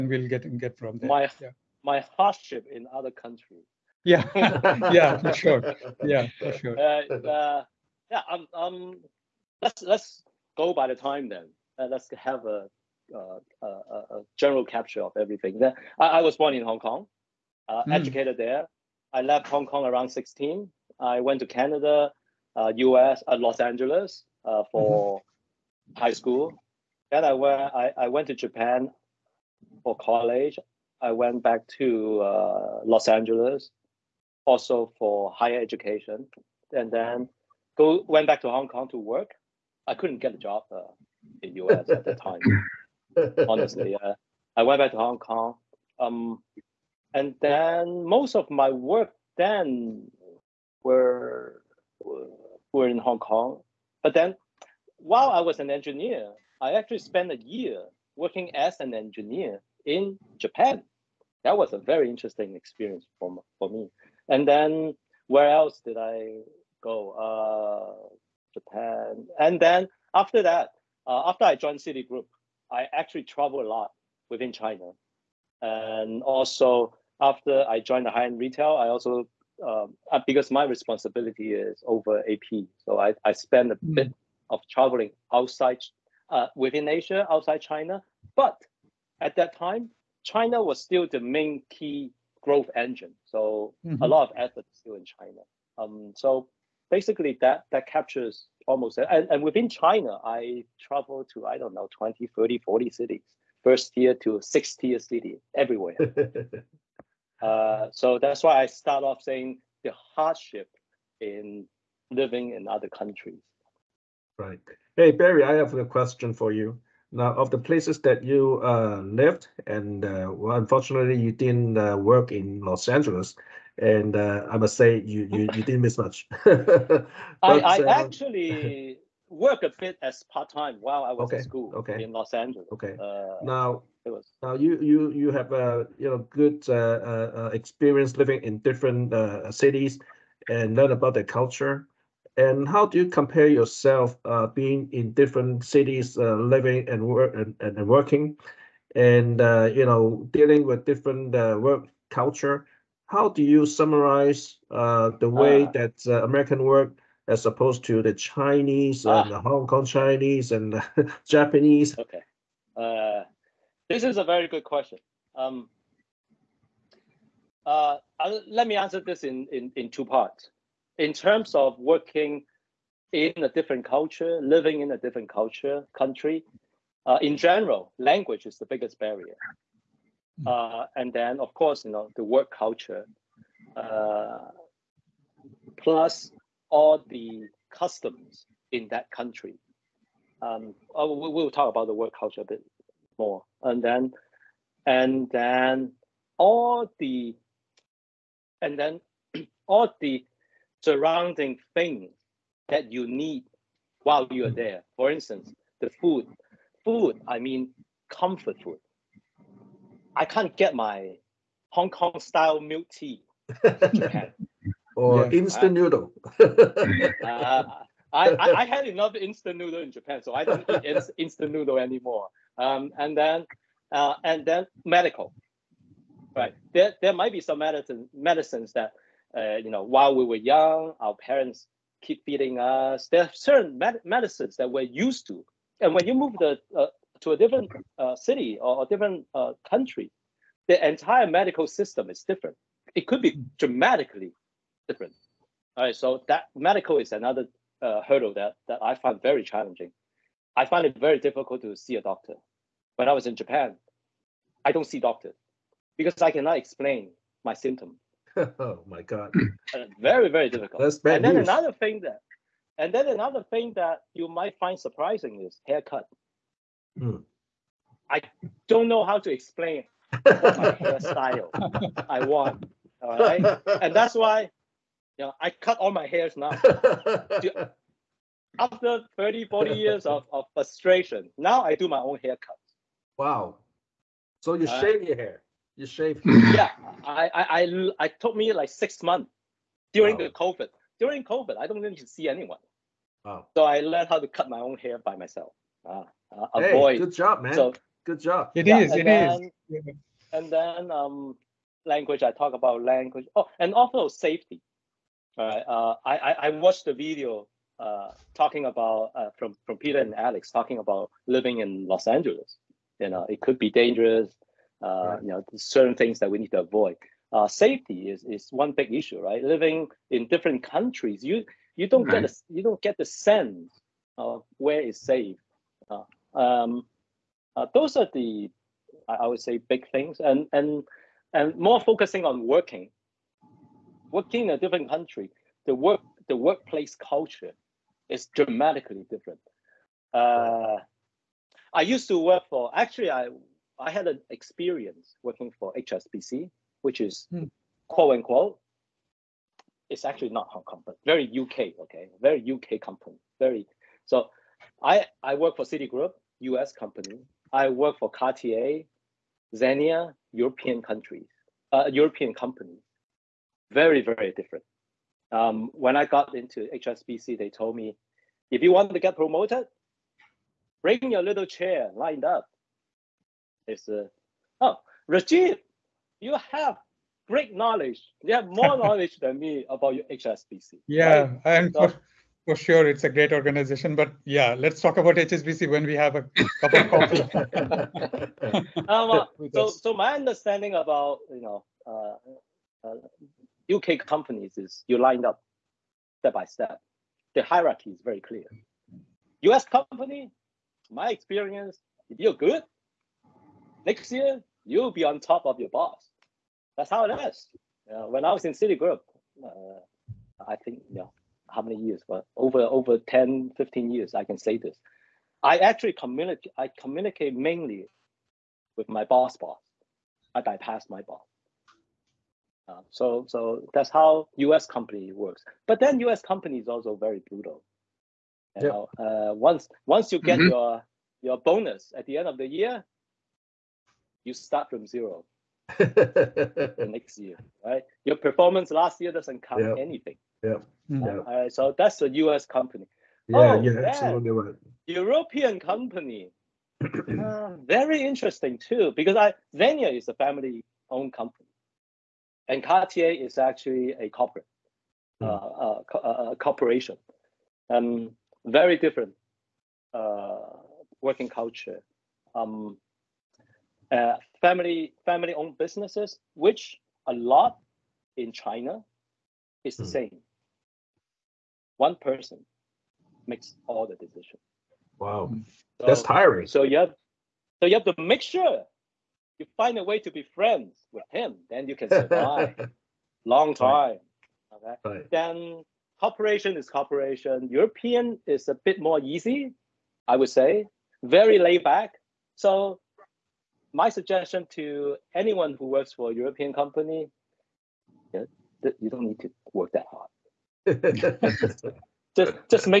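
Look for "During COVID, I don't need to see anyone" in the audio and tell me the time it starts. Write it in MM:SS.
04:50.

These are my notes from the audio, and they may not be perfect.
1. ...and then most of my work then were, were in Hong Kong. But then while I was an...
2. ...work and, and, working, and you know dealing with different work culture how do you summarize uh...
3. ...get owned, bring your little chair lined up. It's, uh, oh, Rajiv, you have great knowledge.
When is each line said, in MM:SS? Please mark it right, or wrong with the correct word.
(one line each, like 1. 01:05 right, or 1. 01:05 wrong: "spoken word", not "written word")
1. 00:47 right
2. 02:27 right
3. 06:08 wrong: "promoted", not "owned".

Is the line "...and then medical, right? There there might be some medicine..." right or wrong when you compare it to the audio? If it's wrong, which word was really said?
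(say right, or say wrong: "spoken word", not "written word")
right.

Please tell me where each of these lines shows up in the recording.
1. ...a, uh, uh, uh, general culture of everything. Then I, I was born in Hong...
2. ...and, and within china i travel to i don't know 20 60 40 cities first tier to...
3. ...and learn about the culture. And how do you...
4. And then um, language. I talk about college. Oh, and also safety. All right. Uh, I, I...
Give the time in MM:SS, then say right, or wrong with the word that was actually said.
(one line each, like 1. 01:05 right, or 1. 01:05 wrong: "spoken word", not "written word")
1. 00:13 wrong: "capture", not "culture"
2. 01:38 wrong: "30", not "60"
3. 02:20 right
4. 05:00 wrong: "language", not "college".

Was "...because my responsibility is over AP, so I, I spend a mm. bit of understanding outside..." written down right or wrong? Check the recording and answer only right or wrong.
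wrong.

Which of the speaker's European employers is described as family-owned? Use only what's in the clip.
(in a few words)
Zegna.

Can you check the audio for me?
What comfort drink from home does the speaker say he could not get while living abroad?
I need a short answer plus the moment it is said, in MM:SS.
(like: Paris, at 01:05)
Hong Kong style milk tea, at 03:31.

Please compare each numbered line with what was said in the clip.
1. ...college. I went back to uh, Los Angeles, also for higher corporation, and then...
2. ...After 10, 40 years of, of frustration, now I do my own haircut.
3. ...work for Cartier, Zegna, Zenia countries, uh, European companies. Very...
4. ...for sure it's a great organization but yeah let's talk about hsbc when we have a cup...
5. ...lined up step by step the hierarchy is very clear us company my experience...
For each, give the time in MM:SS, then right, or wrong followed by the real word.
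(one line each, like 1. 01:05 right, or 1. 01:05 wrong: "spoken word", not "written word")
1. 00:29 wrong: "education", not "corporation"
2. 04:38 wrong: "30", not "10"
3. 05:57 wrong: "European", not "Zenia"
4. 06:22 right
5. 06:34 right.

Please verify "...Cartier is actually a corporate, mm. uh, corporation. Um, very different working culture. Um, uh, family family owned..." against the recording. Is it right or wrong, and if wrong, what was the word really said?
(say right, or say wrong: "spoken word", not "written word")
right.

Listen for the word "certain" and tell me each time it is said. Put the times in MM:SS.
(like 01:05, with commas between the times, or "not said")
03:53, 05:15.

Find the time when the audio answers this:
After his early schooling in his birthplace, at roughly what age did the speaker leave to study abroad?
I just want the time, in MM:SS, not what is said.
00:20.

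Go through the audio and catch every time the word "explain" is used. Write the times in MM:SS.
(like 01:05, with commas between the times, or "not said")
04:16, 04:29.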